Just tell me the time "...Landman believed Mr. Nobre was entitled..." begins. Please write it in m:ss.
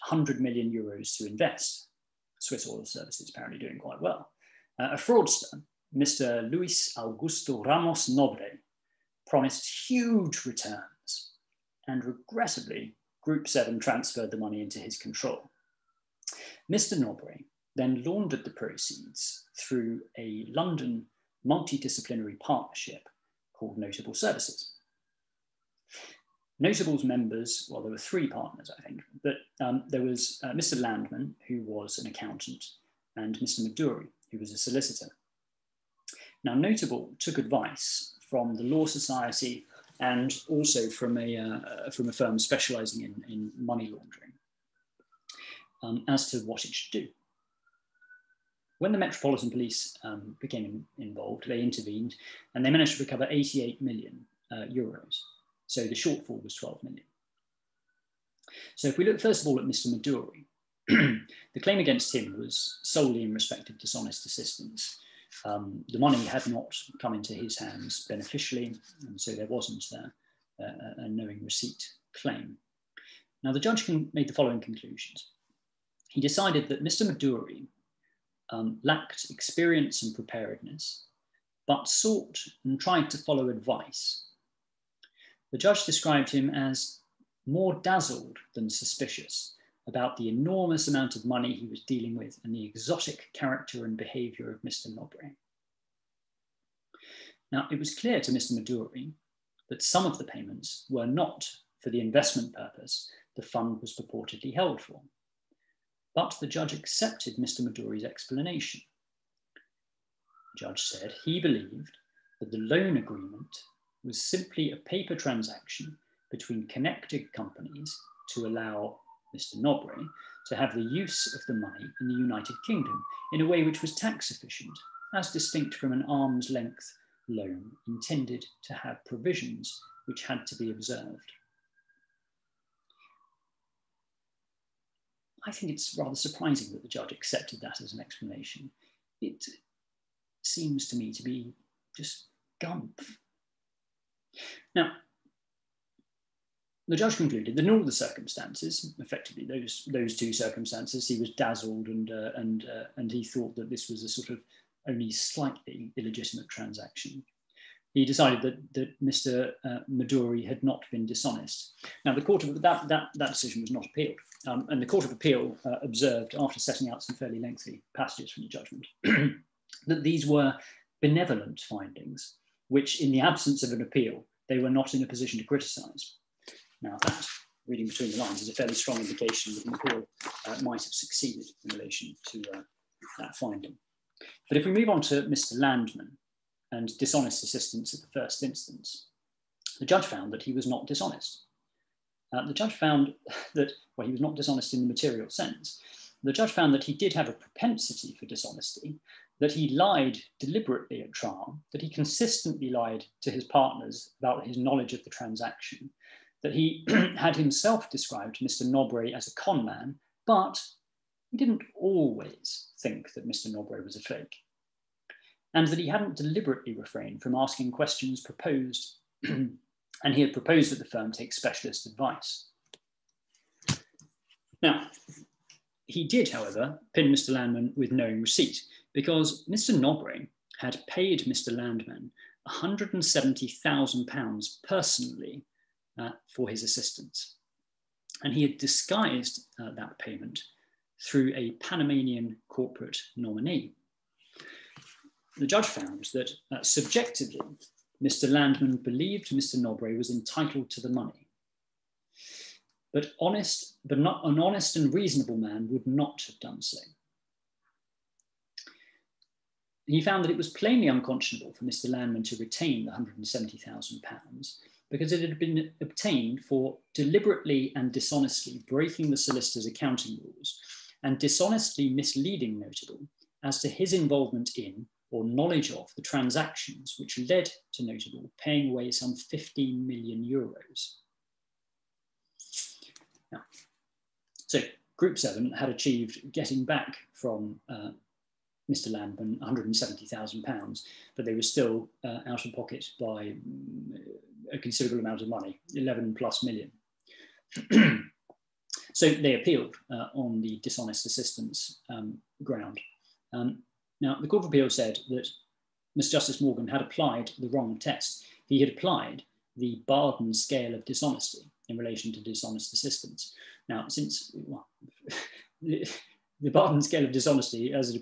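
4:08.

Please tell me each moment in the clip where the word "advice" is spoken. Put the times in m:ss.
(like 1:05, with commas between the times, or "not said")
0:37, 1:23, 3:41.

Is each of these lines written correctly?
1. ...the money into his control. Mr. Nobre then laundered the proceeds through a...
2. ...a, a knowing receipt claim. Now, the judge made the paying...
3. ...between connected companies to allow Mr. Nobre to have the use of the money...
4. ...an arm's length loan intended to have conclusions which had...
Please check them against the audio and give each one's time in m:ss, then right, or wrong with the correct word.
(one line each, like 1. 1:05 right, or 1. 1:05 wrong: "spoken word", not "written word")
1. 0:14 right
2. 1:10 wrong: "following", not "paying"
3. 1:56 right
4. 2:05 wrong: "provisions", not "conclusions".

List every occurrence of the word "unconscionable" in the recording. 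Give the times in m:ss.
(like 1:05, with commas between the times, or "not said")
4:20.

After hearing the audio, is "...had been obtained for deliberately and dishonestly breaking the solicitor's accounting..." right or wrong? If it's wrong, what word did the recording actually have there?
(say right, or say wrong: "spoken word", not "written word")
right.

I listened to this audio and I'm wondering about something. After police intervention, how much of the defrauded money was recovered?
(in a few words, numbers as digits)
88 million euros.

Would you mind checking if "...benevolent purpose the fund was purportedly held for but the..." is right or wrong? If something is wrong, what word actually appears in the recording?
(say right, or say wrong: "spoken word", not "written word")
wrong: "investment", not "benevolent".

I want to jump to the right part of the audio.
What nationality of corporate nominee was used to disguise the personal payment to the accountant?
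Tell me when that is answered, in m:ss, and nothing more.
4:01.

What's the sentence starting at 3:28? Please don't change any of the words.
Nobre as a con man, but he didn't always think that Mr.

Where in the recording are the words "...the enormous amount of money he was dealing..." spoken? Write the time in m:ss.
1:30.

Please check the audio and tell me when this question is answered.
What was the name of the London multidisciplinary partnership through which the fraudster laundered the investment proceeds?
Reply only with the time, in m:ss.
0:23.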